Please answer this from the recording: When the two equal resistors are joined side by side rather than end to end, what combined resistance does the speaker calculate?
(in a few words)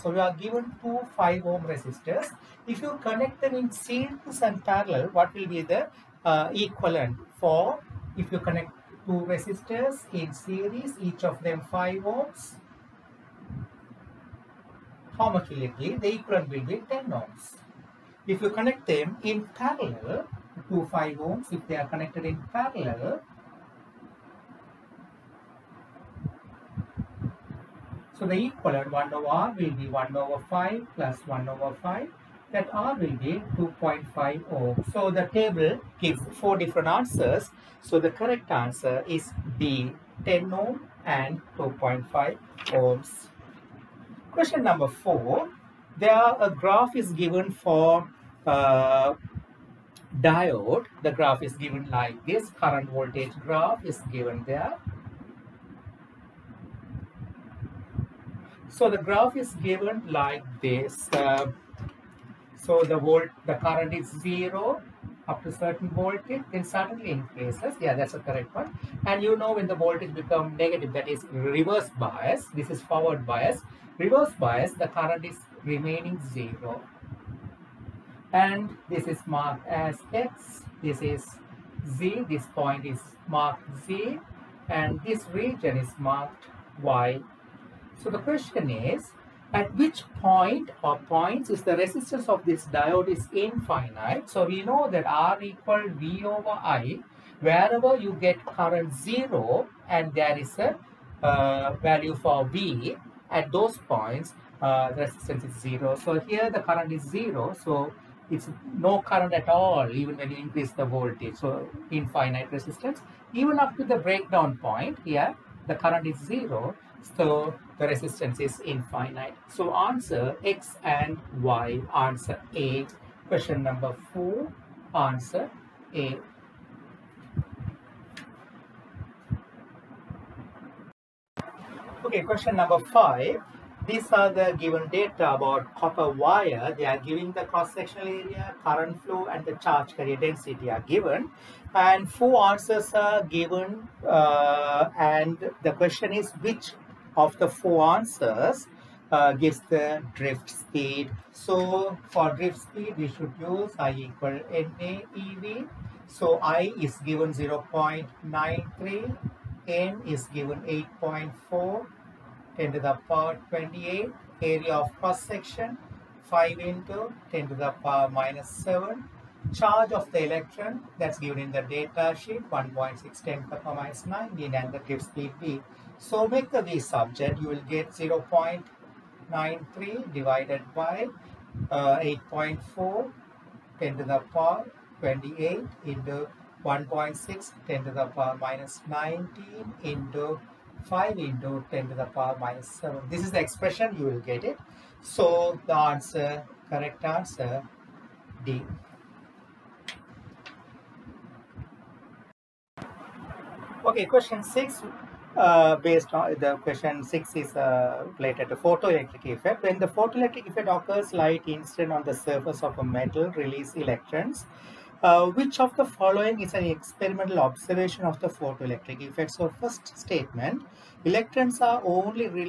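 2.5 ohm.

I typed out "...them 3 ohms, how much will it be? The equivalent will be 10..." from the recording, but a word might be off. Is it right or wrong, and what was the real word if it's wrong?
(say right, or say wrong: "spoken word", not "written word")
wrong: "5", not "3".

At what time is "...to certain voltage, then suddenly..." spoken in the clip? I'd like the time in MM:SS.
01:05.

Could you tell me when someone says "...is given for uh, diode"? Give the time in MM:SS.
00:46.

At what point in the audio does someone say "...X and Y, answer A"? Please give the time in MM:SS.
02:00.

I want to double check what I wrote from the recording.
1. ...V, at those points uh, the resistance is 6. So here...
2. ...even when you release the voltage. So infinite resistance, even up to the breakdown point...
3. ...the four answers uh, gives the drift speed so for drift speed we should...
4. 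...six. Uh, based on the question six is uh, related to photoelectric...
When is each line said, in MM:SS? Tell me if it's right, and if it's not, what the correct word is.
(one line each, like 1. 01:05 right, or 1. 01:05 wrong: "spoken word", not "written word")
1. 01:42 wrong: "0", not "6"
2. 01:49 wrong: "increase", not "release"
3. 02:27 right
4. 03:24 right.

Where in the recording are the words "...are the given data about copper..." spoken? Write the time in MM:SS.
02:14.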